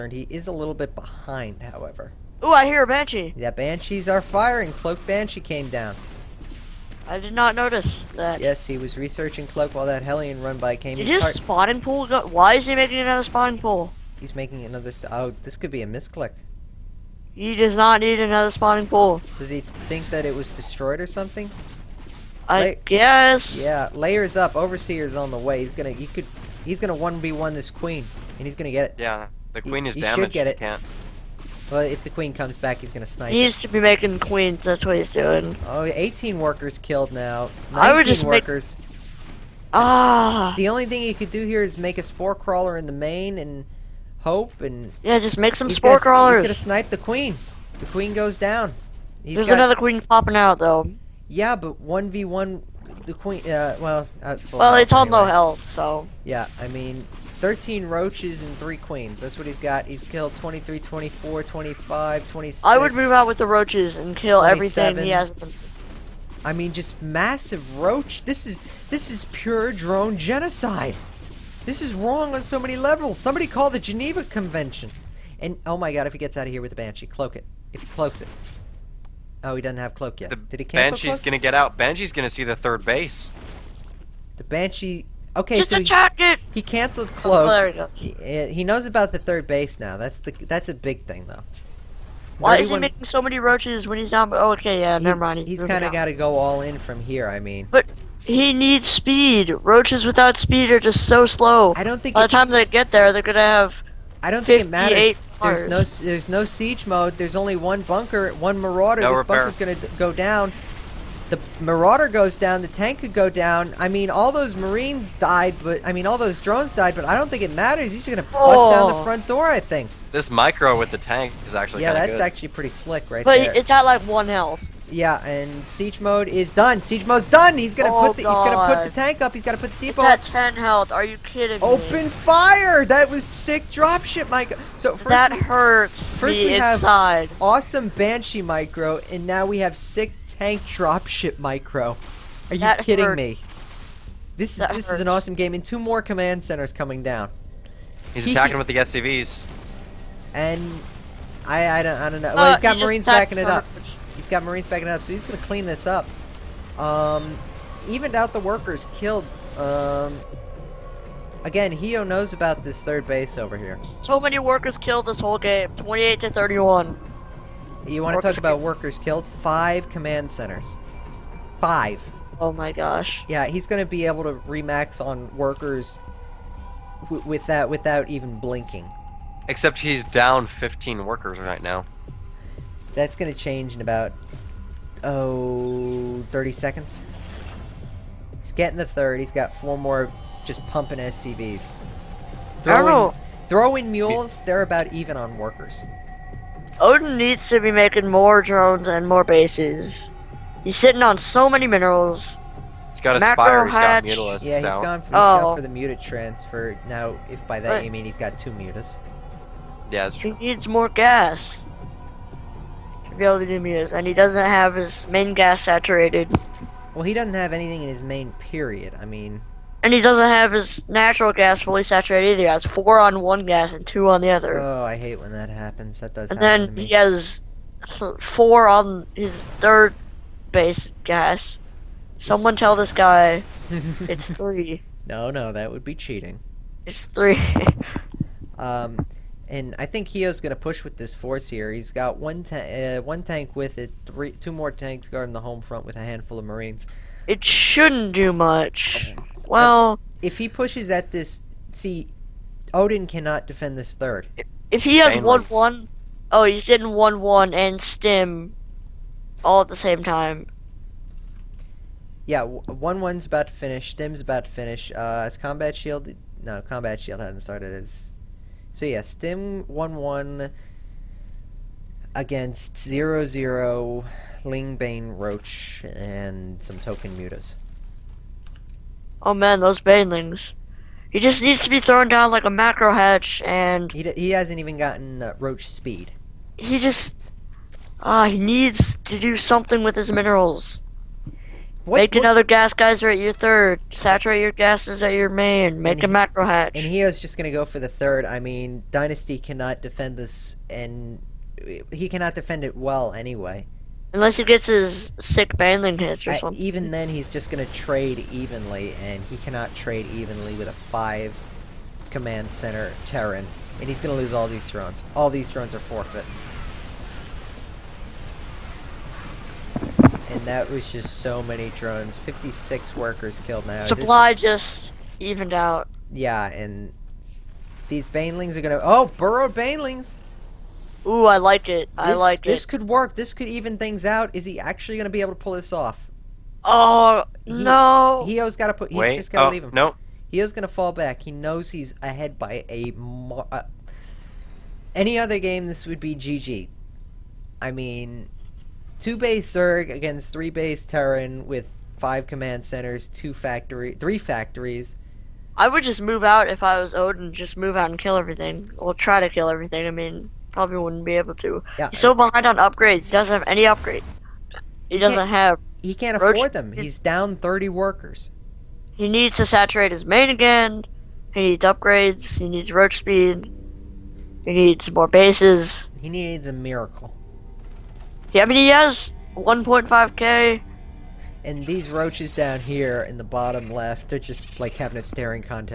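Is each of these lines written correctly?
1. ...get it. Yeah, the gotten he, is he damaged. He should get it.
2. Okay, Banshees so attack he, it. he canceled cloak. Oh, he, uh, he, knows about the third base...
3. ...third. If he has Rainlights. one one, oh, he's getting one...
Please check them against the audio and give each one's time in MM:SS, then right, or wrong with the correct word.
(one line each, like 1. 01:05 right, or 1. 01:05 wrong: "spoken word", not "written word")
1. 00:28 wrong: "queen", not "gotten"
2. 01:25 wrong: "Just", not "Banshees"
3. 04:13 right.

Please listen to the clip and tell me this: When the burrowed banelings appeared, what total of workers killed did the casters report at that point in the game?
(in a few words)
56.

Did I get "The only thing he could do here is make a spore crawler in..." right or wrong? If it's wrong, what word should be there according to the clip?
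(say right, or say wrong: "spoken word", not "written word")
right.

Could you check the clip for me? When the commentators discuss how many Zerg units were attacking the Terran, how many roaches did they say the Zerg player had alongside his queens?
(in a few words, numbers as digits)
13.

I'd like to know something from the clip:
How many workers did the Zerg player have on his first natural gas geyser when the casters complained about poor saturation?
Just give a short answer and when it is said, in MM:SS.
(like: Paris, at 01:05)
4, at 03:42.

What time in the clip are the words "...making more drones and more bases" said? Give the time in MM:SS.
03:17.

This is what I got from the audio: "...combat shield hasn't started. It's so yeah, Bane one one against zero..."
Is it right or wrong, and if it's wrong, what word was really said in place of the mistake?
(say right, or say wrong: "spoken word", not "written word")
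wrong: "Stim", not "Bane".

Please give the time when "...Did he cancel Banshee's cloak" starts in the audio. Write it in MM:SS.
01:20.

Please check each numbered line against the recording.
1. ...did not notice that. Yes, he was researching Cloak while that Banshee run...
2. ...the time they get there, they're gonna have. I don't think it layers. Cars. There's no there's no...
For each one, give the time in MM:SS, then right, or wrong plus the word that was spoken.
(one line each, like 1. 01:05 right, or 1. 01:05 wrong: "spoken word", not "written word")
1. 00:07 wrong: "Hellion", not "Banshee"
2. 01:42 wrong: "matters", not "layers".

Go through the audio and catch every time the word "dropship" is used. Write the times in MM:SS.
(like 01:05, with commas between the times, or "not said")
02:13, 02:20.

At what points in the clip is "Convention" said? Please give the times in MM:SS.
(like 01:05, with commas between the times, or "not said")
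01:14.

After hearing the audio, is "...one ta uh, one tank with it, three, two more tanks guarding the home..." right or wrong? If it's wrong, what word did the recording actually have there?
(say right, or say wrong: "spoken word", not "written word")
right.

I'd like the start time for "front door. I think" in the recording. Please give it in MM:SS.
01:59.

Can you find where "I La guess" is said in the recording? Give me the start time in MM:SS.
00:22.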